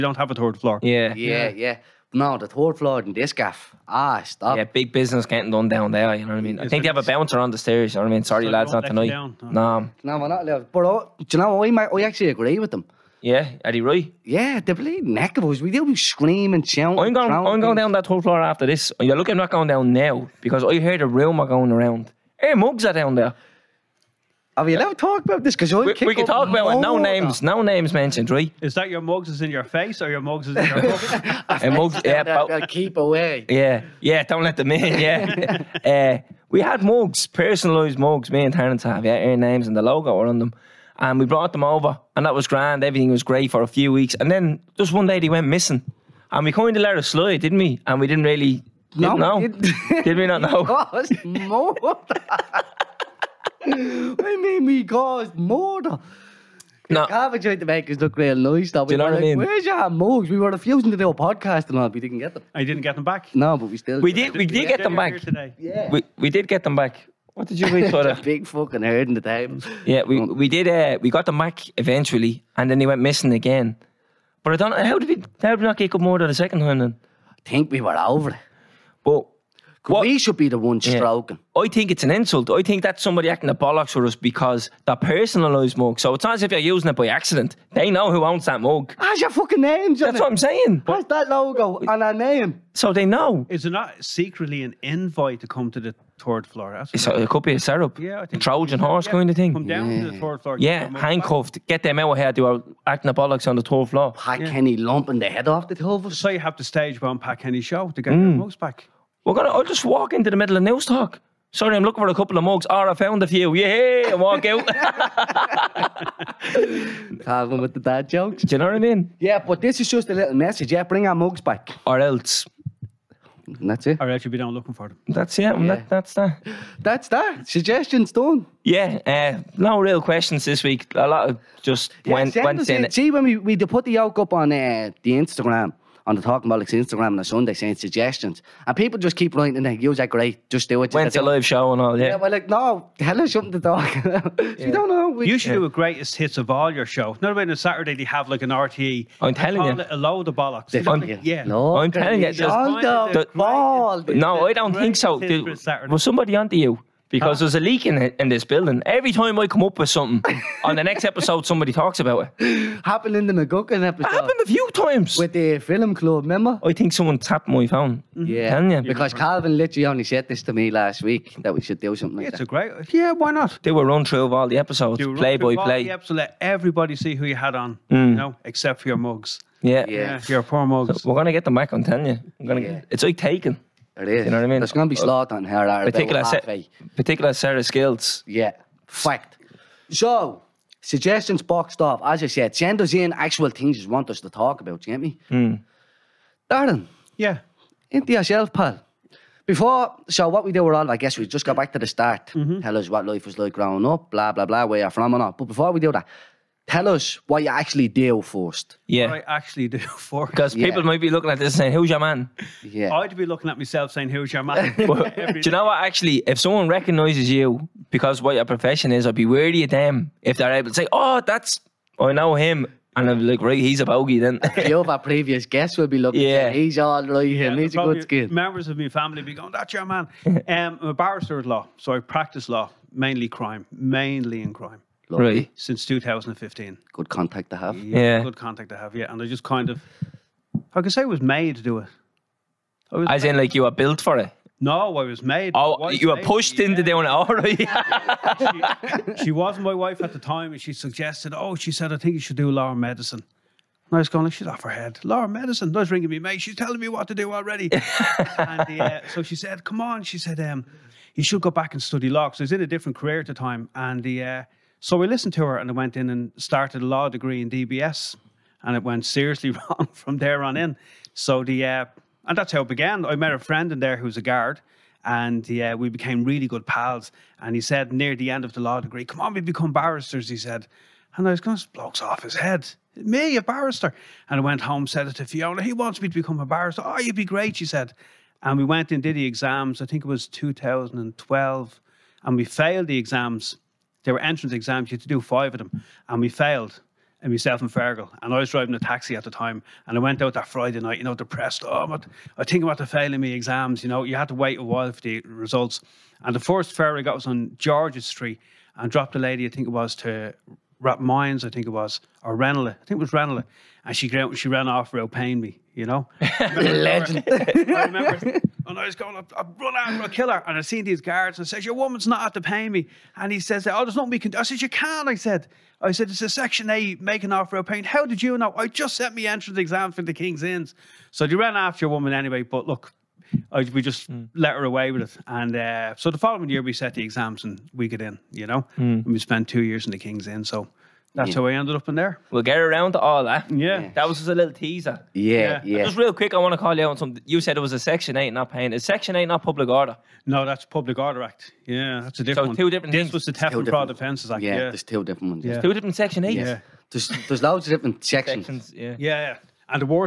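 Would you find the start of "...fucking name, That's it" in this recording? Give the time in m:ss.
1:29.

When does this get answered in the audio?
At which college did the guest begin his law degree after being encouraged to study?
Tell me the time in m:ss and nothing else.
4:27.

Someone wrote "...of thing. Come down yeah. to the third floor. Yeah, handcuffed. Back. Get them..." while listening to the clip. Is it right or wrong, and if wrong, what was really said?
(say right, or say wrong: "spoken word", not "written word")
right.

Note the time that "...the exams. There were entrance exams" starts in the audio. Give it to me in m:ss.
4:52.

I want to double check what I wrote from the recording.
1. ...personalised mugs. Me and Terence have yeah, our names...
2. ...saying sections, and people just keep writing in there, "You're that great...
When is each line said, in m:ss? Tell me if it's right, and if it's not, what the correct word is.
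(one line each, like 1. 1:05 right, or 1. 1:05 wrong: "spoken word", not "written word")
1. 0:37 right
2. 2:17 wrong: "suggestions", not "sections".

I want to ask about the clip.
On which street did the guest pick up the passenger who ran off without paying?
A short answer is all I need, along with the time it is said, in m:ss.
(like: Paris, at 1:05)
George's Street, at 5:07.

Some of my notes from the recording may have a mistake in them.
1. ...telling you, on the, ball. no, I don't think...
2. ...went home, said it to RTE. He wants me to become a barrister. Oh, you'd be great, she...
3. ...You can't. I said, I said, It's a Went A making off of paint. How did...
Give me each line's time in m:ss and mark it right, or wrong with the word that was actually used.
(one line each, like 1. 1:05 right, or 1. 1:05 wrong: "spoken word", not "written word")
1. 2:31 right
2. 4:44 wrong: "Fiona", not "RTE"
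3. 5:24 wrong: "Section", not "Went".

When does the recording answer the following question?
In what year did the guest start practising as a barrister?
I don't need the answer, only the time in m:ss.
3:55.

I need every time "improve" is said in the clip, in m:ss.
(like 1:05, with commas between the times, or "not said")
not said.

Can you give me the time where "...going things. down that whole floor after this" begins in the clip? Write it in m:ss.
0:17.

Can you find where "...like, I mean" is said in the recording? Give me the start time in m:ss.
0:59.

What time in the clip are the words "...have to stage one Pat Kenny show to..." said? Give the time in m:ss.
1:46.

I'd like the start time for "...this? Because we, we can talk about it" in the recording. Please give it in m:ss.
0:25.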